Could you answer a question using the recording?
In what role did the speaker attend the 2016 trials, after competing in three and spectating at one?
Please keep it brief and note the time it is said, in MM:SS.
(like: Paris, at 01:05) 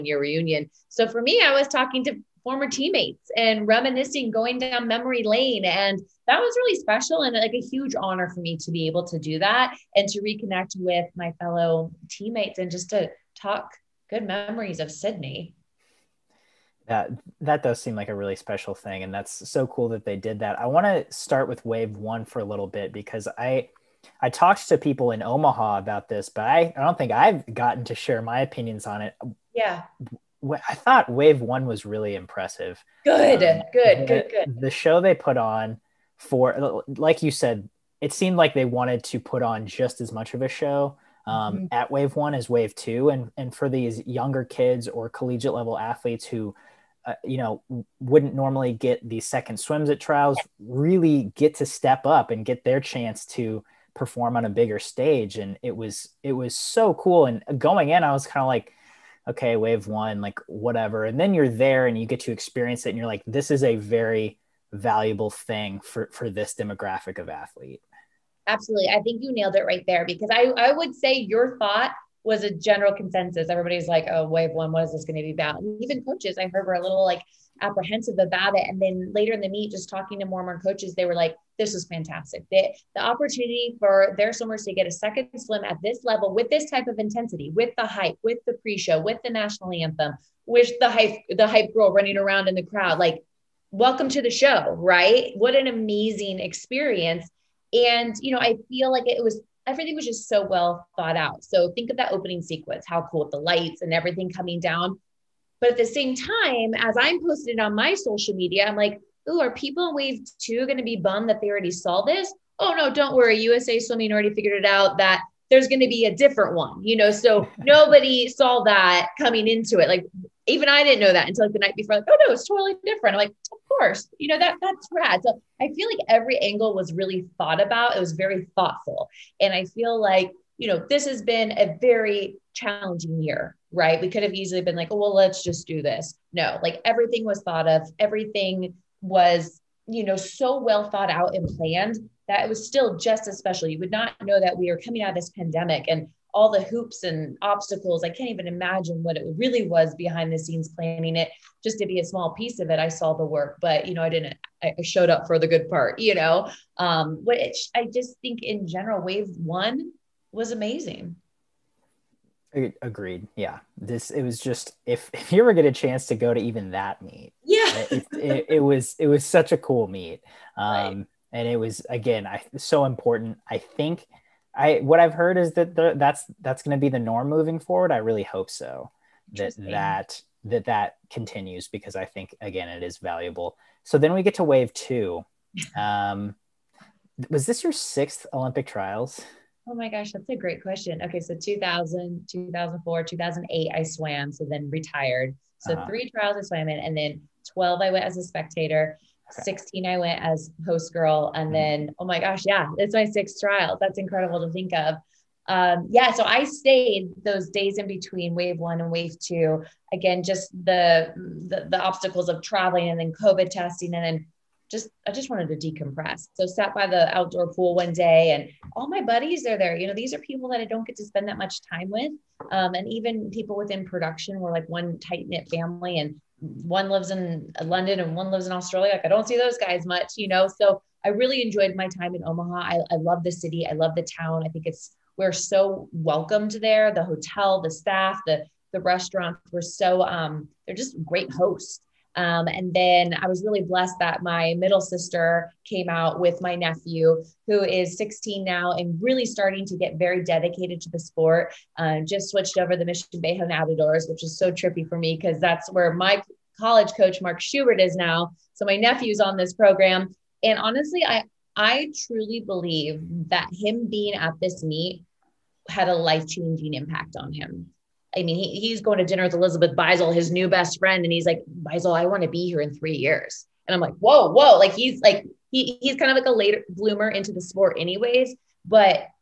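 host girl, at 03:20.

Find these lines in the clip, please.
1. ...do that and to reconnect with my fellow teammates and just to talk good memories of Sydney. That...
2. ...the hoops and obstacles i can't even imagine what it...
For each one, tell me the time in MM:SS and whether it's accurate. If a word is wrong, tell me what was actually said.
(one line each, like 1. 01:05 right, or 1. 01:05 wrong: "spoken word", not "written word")
1. 00:09 right
2. 02:26 right.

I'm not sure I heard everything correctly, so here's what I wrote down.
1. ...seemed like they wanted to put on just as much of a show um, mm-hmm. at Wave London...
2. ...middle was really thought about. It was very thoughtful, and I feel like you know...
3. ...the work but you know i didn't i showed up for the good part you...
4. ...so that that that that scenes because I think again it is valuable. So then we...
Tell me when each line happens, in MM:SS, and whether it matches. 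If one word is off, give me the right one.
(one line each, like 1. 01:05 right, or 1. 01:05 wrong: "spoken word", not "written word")
1. 00:38 wrong: "One", not "London"
2. 02:06 wrong: "angle", not "middle"
3. 02:33 right
4. 02:58 wrong: "continues", not "scenes".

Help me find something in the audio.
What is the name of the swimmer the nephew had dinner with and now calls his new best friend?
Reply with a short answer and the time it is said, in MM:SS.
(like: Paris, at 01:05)
Elizabeth Beisel, at 04:29.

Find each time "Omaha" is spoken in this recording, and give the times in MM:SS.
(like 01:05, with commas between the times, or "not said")
00:25, 03:52.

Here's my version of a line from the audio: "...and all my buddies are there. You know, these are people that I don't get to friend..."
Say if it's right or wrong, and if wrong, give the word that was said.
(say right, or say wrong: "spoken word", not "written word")
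wrong: "spend", not "friend".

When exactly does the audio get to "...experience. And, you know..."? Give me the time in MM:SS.
01:36.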